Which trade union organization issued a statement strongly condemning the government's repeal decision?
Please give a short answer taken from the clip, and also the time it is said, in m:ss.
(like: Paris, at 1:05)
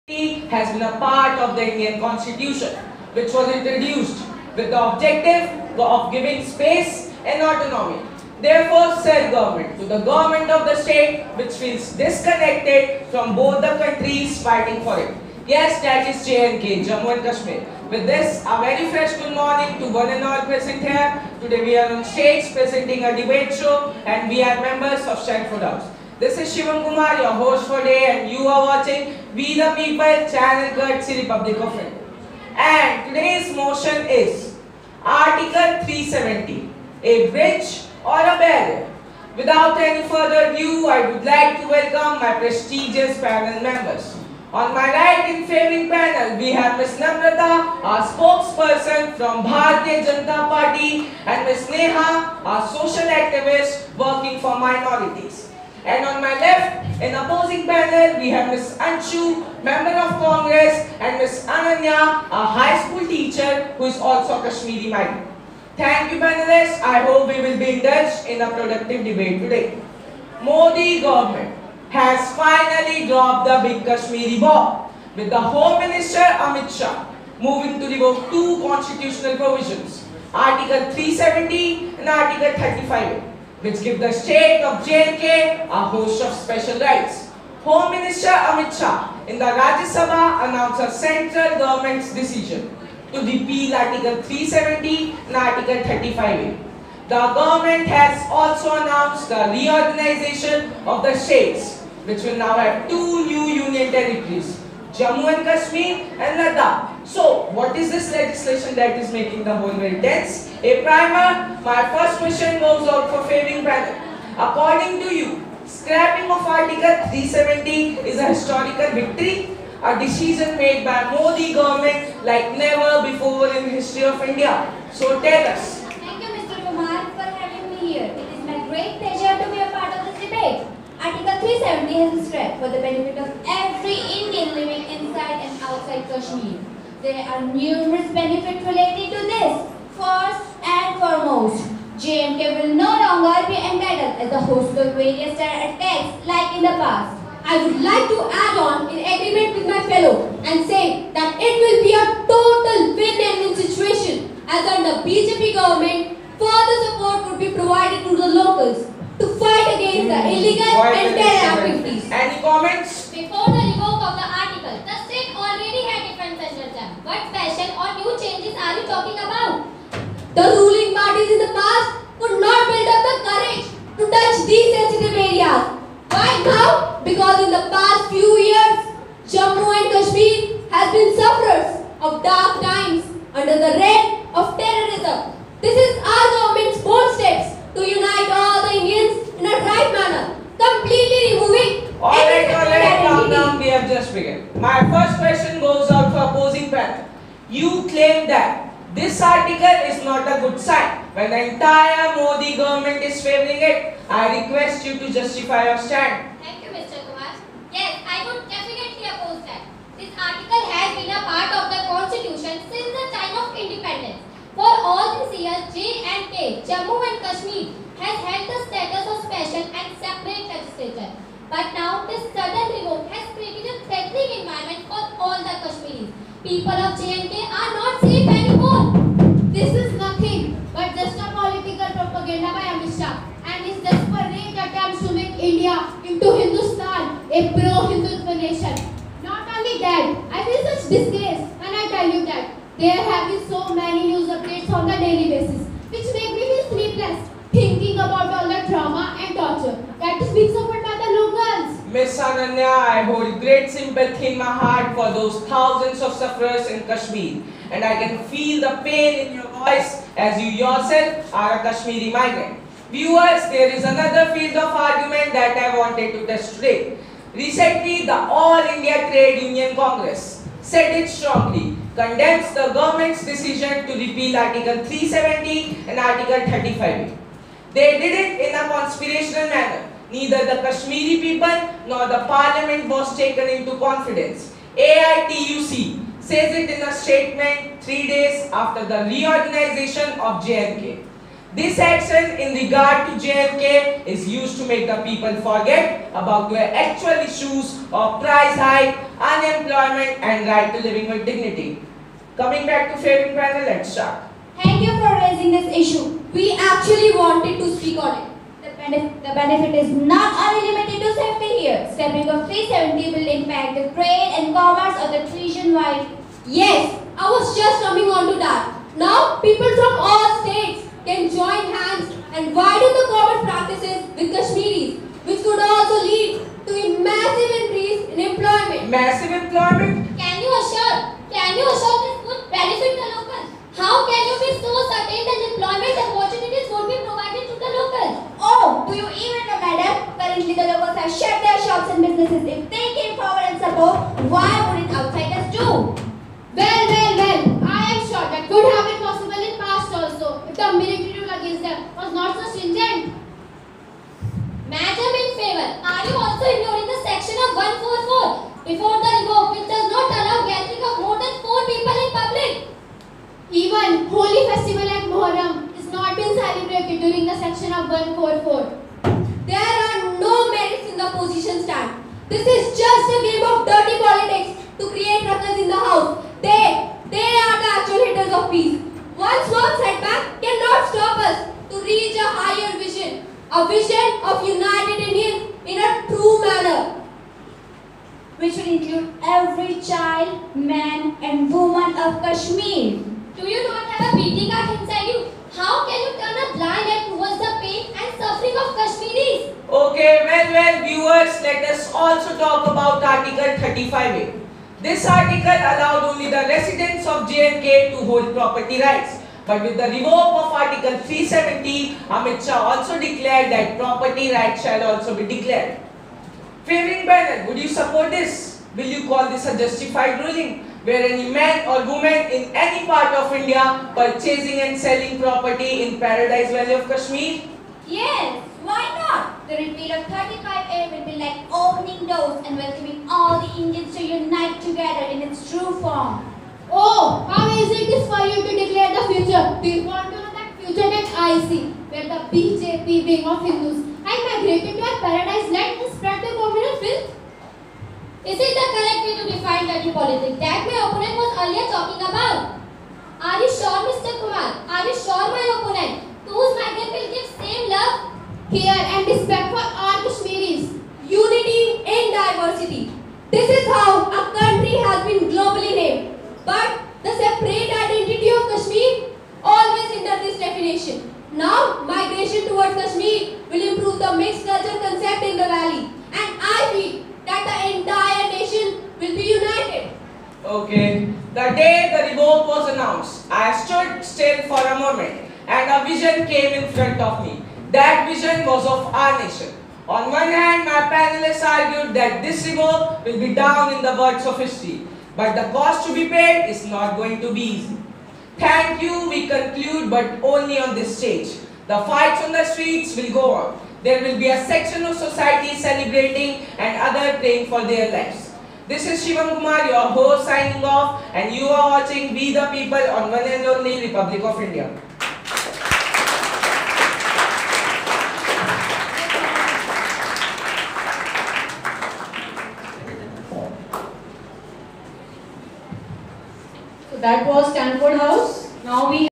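All India Trade Union Congress, at 4:28.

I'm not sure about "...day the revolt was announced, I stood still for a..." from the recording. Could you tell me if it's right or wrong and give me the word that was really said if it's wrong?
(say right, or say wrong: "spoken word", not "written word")
right.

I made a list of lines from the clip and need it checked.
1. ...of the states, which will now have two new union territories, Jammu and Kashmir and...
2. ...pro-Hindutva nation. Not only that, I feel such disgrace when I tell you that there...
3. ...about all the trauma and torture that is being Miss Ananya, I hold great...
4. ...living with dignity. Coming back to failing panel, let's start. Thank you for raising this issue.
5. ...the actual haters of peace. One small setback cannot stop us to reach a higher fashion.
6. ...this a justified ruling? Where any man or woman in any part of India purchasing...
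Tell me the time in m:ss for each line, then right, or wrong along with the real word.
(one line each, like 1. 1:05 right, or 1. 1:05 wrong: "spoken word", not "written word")
1. 1:40 right
2. 3:57 right
3. 4:07 right
4. 5:00 right
5. 6:17 wrong: "vision", not "fashion"
6. 6:59 right.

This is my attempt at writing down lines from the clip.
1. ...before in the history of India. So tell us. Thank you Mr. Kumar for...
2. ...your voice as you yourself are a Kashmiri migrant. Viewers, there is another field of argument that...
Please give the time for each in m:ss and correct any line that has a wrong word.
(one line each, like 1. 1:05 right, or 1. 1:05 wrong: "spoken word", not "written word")
1. 2:03 right
2. 4:19 right.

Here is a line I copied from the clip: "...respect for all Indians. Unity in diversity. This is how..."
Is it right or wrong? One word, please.
wrong.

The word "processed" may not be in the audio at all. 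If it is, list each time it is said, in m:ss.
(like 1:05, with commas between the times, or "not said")
not said.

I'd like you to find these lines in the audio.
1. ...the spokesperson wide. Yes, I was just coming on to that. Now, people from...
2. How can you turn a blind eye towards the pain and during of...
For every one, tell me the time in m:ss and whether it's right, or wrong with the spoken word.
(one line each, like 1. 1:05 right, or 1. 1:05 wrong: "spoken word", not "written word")
1. 5:15 wrong: "region", not "spokesperson"
2. 6:35 wrong: "suffering", not "during".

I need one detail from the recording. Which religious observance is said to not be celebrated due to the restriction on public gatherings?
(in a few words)
Muharram.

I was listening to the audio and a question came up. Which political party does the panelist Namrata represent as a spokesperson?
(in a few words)
Bharatiya Janata Party.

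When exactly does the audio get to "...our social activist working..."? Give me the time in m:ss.
0:52.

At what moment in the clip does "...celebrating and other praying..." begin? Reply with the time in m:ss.
8:25.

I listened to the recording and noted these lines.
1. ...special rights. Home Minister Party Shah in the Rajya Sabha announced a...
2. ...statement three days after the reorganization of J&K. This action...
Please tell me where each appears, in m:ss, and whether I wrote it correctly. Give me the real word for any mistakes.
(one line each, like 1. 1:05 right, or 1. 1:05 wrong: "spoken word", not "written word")
1. 1:26 wrong: "Amit", not "Party"
2. 4:46 right.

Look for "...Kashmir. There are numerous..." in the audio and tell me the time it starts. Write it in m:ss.
2:16.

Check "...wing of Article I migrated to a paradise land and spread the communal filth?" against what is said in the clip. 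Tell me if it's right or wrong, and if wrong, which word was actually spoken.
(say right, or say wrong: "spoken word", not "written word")
wrong: "Hindus", not "Article".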